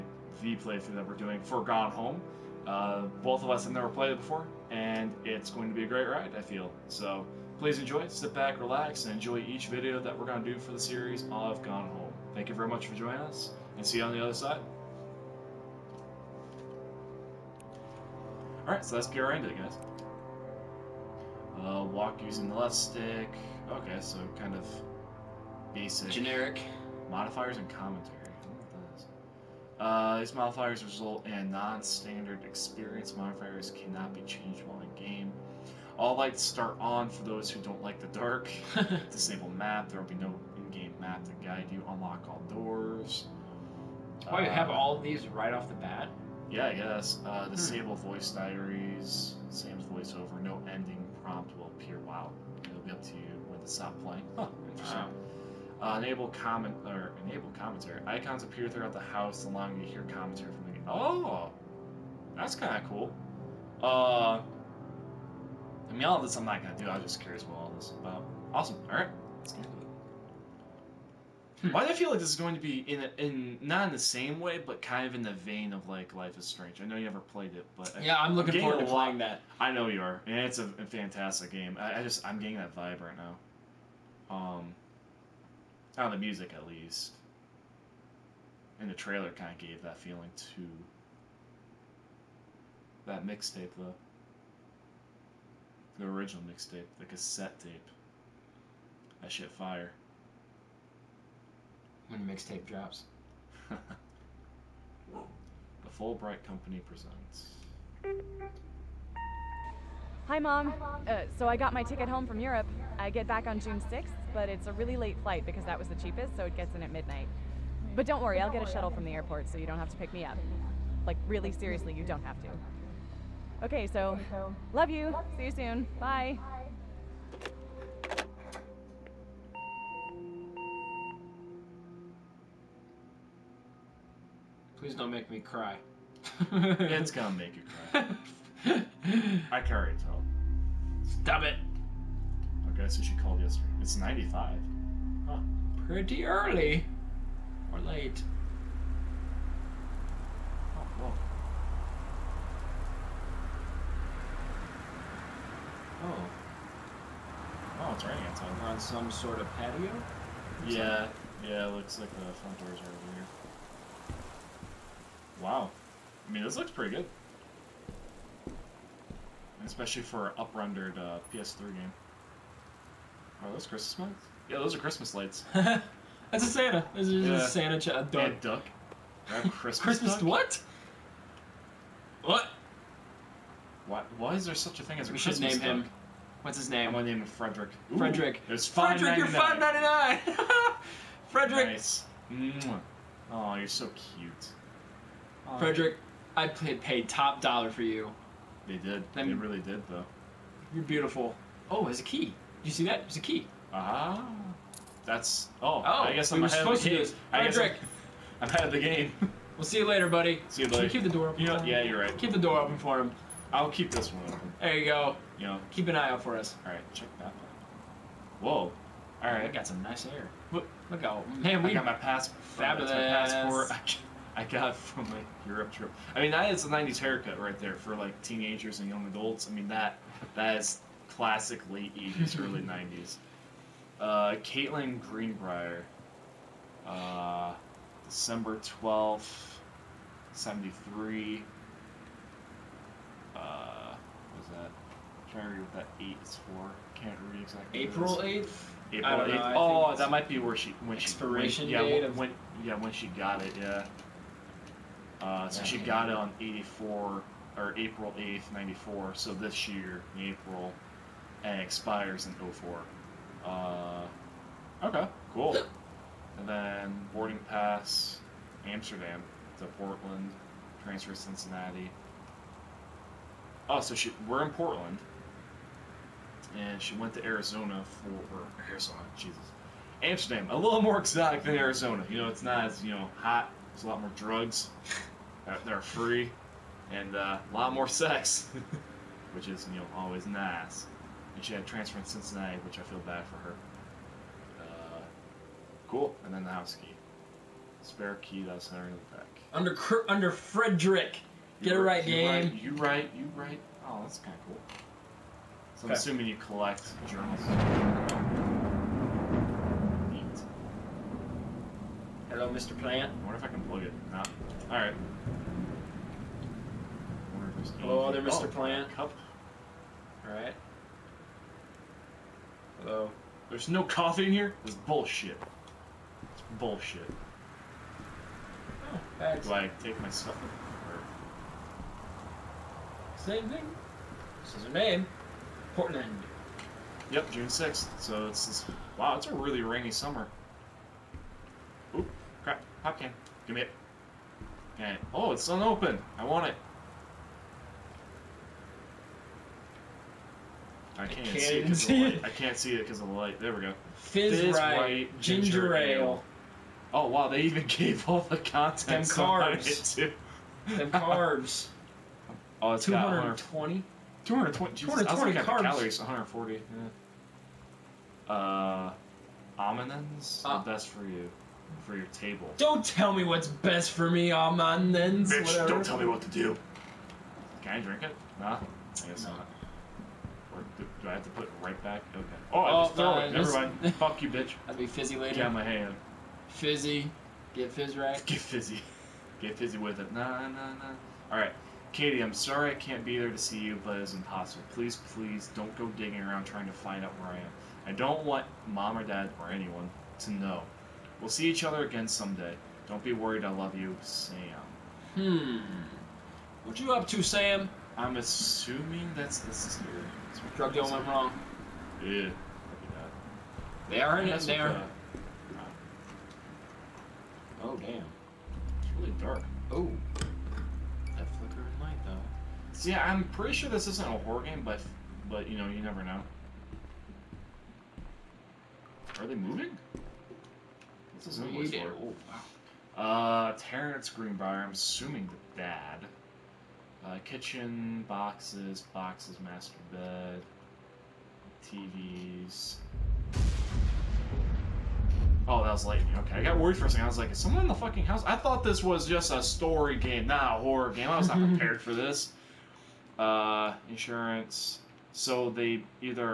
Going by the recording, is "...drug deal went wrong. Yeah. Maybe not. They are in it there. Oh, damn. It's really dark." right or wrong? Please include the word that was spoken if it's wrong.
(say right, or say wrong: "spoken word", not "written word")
right.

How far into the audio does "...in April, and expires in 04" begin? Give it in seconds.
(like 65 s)
260 s.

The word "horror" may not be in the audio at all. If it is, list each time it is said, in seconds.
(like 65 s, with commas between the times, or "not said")
424 s, 450 s.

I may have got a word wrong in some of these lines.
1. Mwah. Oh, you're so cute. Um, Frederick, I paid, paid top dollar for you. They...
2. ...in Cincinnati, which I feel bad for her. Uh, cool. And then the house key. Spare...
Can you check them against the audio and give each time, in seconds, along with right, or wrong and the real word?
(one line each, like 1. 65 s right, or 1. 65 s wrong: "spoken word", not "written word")
1. 192 s right
2. 291 s right.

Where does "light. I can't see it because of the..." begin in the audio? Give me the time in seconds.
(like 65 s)
352 s.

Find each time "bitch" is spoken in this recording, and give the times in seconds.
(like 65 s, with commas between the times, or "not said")
375 s, 384 s.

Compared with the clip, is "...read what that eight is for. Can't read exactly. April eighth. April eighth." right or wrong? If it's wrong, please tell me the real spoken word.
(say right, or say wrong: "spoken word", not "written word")
right.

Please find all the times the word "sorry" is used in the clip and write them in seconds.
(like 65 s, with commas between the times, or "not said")
392 s.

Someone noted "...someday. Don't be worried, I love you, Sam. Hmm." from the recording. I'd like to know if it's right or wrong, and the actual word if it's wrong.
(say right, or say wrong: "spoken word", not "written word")
right.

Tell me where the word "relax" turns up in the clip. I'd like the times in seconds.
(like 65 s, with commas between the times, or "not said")
8 s.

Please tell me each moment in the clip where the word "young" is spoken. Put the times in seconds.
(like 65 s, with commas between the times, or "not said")
228 s.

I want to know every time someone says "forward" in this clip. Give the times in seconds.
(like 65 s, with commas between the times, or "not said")
78 s.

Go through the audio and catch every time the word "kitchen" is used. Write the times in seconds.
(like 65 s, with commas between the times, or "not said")
437 s.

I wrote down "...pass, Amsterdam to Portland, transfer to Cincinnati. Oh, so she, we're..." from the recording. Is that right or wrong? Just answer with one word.
right.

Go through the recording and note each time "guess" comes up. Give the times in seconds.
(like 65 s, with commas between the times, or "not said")
46 s, 206 s, 379 s.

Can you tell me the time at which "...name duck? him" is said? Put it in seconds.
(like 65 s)
185 s.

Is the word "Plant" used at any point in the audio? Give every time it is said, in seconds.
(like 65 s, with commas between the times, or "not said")
312 s, 318 s.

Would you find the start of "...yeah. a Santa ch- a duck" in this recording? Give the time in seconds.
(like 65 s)
177 s.